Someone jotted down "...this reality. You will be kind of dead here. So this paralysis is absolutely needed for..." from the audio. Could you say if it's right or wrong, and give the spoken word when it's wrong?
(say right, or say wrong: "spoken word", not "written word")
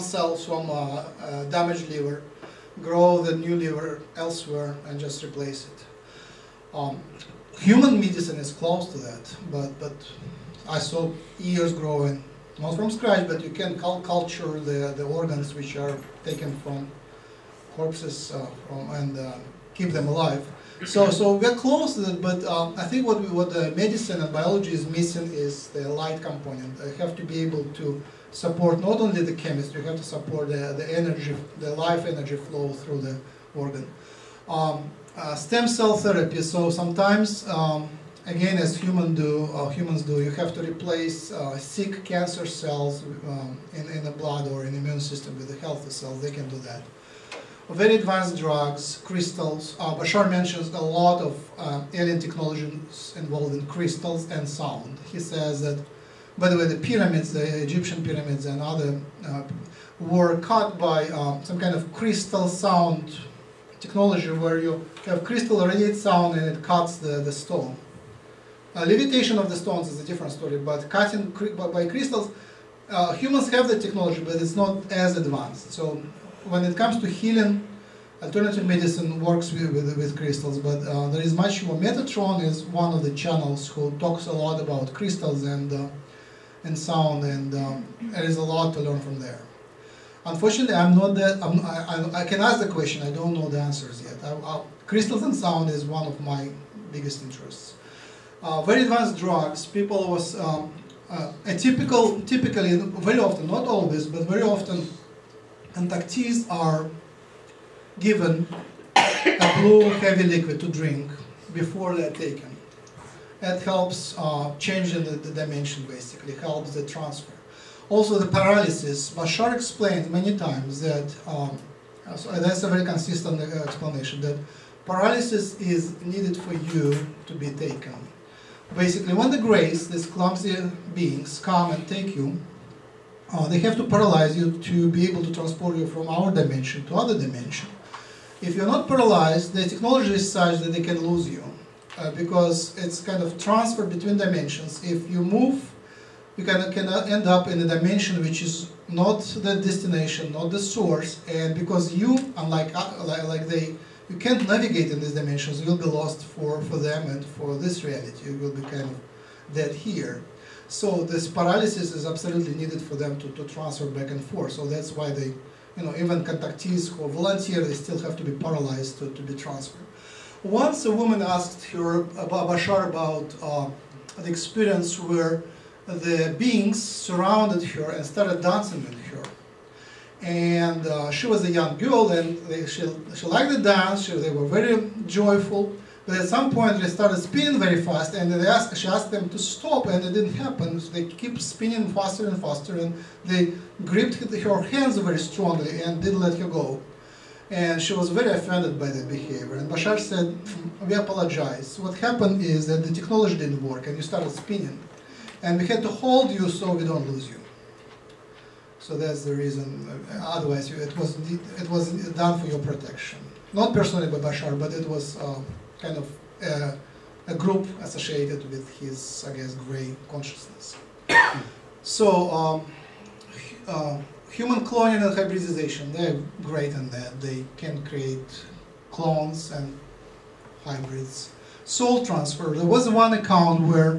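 right.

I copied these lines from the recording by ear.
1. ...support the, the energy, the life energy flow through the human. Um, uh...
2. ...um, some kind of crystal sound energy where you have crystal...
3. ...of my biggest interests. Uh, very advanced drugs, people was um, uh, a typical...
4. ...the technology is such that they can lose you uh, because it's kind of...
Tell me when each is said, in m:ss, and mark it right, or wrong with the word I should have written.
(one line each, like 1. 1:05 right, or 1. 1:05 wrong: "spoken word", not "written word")
1. 0:30 wrong: "organ", not "human"
2. 1:01 wrong: "technology", not "energy"
3. 1:36 right
4. 2:19 right.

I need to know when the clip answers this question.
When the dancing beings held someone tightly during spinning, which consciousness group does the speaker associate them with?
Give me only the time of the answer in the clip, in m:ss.
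3:39.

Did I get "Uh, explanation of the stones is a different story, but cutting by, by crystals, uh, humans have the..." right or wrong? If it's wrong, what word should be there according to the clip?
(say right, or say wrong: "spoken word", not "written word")
wrong: "levitation", not "explanation".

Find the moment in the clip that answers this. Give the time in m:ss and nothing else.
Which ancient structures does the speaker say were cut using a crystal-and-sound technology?
0:57.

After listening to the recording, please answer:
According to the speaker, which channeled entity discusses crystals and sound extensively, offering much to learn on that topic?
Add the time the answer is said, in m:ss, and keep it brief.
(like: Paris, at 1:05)
Metatron, at 1:21.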